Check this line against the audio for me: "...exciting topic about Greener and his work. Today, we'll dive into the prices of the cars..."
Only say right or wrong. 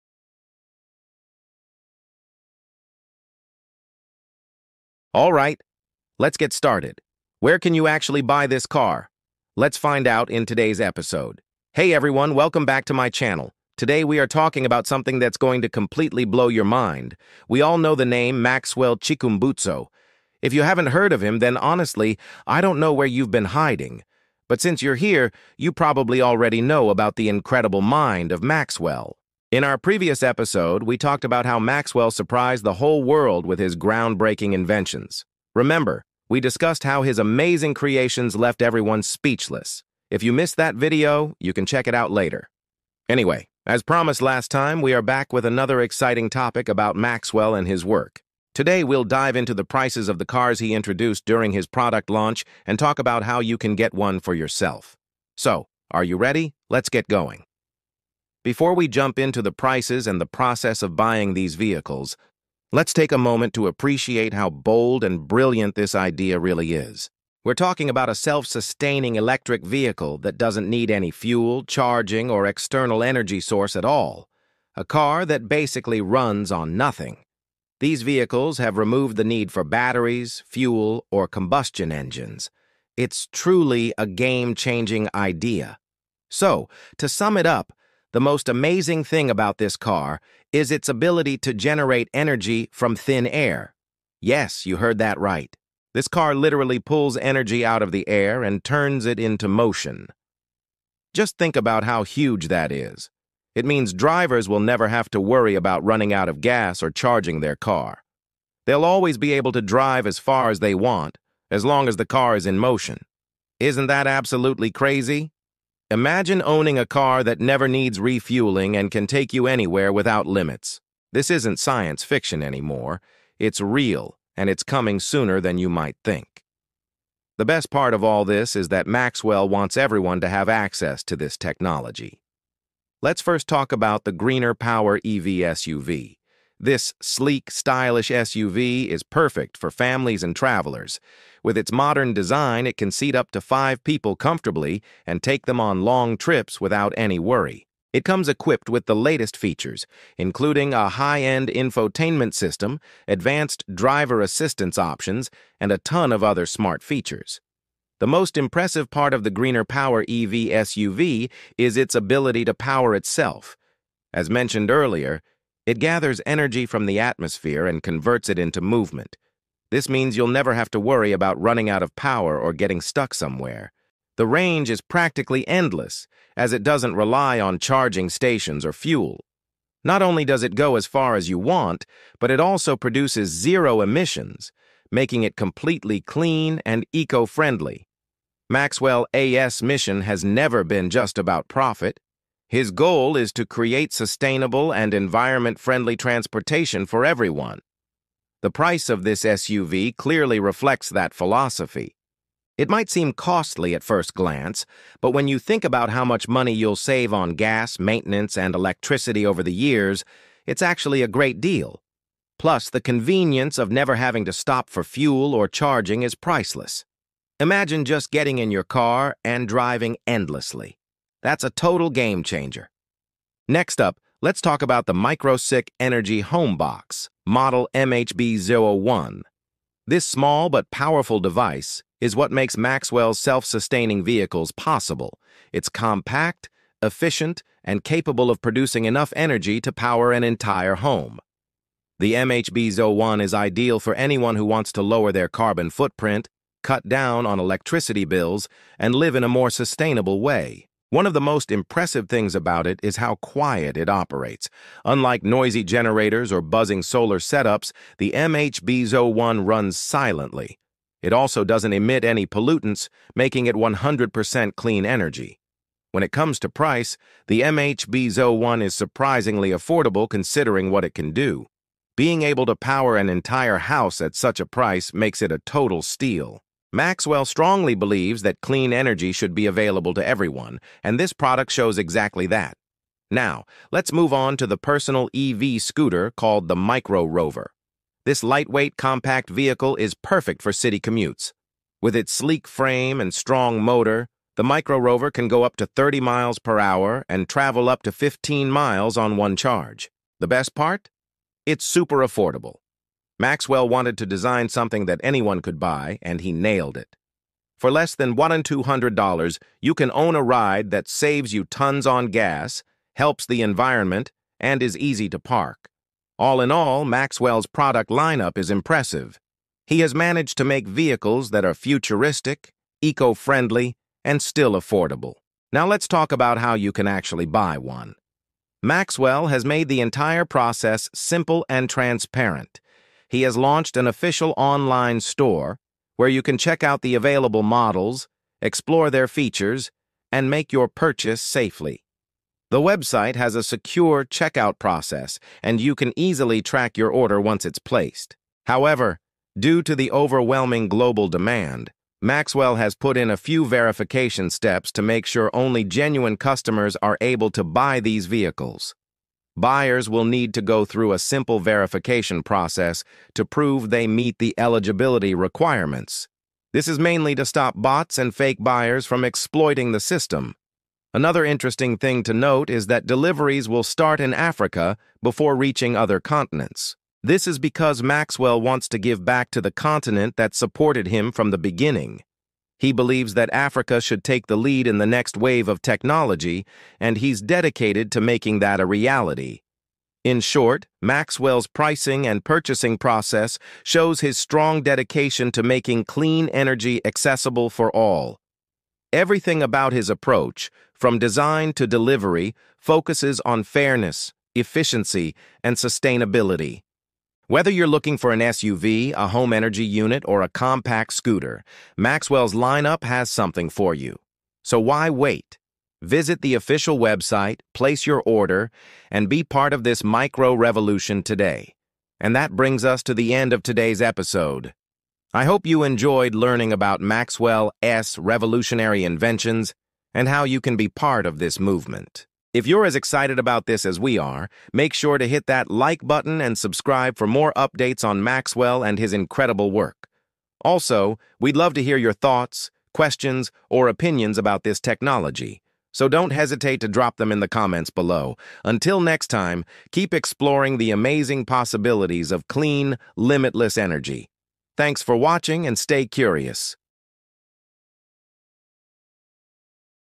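wrong.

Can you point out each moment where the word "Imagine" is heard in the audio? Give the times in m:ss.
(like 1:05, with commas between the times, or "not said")
1:55, 3:37.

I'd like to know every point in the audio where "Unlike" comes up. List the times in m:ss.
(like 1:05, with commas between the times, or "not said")
4:14.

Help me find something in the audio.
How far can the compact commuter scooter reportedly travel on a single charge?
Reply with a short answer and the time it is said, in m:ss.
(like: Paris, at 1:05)
15 miles, at 4:57.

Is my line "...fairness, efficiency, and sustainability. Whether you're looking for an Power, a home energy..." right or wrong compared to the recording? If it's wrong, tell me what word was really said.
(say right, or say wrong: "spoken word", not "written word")
wrong: "SUV", not "Power".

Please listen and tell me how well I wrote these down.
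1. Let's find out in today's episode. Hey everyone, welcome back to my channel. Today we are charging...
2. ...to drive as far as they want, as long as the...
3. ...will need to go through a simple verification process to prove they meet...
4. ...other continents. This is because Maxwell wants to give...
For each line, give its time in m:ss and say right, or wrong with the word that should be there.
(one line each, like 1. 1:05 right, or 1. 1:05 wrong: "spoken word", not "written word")
1. 0:09 wrong: "talking", not "charging"
2. 1:49 right
3. 5:59 right
4. 6:15 right.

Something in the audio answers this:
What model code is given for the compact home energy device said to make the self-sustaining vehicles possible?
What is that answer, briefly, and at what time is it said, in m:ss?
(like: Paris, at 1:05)
MHB01, at 3:47.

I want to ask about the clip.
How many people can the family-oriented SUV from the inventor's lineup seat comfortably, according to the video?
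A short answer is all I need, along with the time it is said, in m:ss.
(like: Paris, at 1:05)
5, at 2:23.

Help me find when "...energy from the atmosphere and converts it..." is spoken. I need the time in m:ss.
2:46.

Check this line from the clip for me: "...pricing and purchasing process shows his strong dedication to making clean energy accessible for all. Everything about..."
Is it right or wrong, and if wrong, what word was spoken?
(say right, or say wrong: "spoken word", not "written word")
right.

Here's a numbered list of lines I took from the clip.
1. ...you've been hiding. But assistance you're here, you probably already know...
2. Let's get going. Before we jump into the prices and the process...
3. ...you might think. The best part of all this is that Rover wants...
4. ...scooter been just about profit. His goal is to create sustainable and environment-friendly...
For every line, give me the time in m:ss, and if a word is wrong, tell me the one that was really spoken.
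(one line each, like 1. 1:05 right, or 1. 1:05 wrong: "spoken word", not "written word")
1. 0:23 wrong: "since", not "assistance"
2. 0:56 right
3. 2:05 wrong: "Maxwell", not "Rover"
4. 3:10 wrong: "never", not "scooter".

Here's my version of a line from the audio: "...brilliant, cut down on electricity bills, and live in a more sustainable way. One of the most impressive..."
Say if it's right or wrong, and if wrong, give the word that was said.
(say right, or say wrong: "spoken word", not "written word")
wrong: "footprint", not "brilliant".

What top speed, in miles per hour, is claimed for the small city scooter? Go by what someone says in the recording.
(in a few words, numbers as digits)
30.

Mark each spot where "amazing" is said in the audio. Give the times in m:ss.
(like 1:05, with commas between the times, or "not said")
0:37, 1:28, 7:30.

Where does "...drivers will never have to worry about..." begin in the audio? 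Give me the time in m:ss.
1:43.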